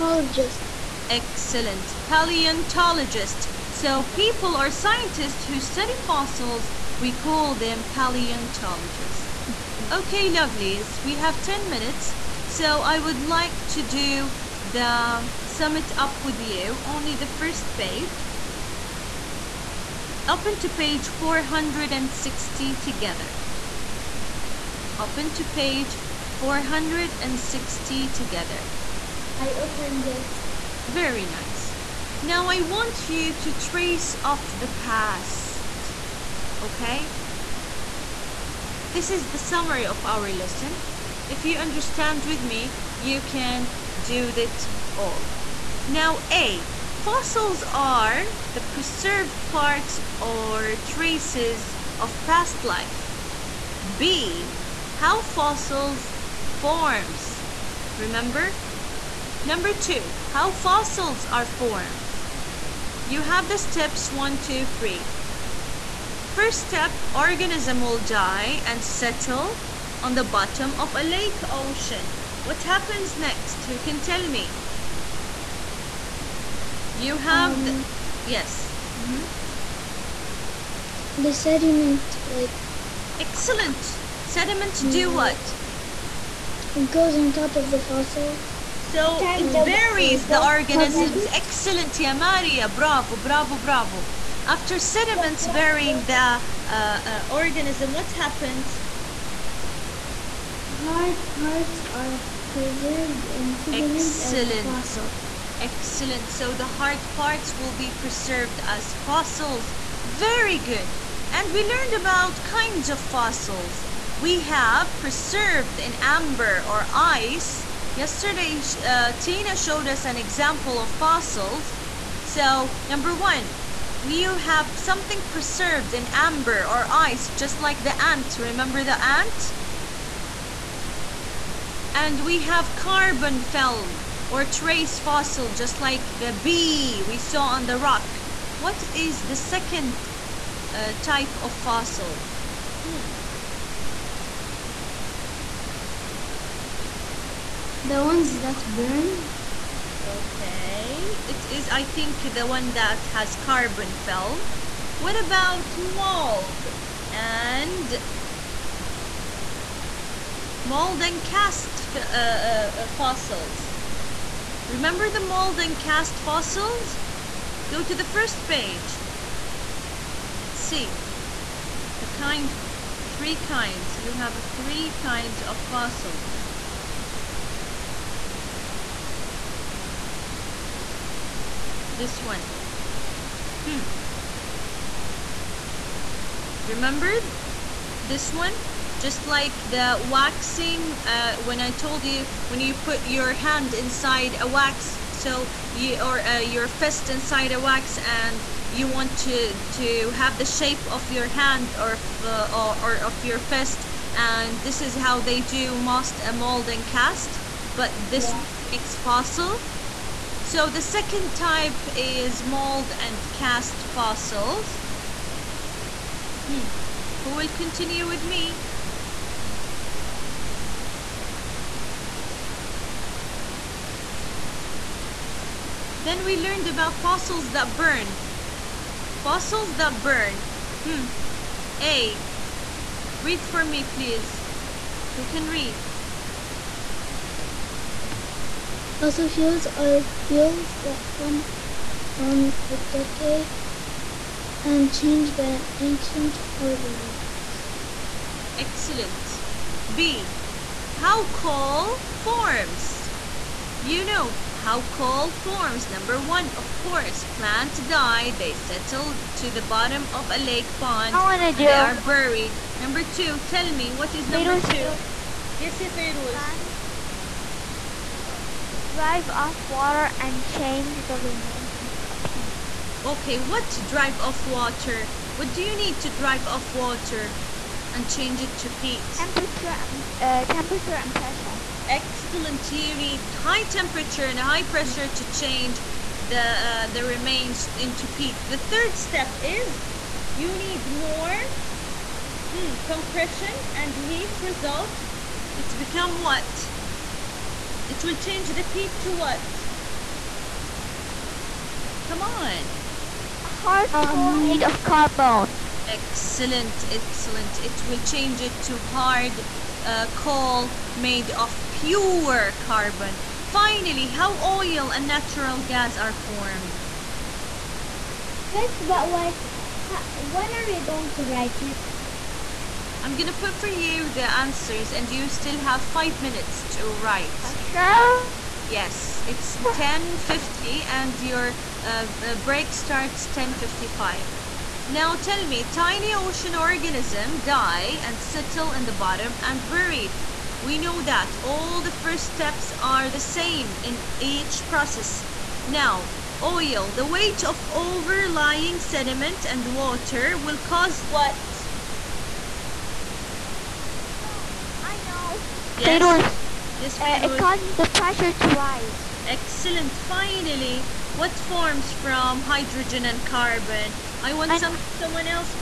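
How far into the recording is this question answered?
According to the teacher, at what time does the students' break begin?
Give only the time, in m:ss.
5:33.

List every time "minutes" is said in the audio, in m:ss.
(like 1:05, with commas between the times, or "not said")
0:11, 5:26.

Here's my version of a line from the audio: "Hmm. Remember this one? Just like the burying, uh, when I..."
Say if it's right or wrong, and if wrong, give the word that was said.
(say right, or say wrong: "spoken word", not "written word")
wrong: "waxing", not "burying".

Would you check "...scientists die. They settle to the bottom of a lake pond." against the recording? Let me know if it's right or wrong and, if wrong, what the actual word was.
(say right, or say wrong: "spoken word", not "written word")
wrong: "plants", not "scientists".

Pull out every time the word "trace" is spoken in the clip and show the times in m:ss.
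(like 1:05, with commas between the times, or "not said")
0:33, 0:50, 2:14.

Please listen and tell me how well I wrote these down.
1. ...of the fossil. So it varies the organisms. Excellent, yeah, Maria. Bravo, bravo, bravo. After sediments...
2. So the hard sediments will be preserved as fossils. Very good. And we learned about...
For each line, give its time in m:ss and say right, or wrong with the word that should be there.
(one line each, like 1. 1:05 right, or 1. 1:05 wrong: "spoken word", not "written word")
1. 1:27 right
2. 1:46 wrong: "parts", not "sediments".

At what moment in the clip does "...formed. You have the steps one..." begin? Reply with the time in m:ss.
1:01.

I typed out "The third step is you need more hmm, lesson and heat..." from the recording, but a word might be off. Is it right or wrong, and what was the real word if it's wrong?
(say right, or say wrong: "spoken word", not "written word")
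wrong: "compression", not "lesson".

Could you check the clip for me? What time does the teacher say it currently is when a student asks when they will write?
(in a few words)
10:50.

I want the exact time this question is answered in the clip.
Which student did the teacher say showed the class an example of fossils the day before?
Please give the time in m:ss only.
1:59.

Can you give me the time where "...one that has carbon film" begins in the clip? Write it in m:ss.
2:32.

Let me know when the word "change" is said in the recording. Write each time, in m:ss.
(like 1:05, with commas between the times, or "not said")
4:04, 4:30, 4:38, 4:45, 4:58, 5:07.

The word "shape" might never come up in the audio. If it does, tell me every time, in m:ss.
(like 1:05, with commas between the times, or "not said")
3:20.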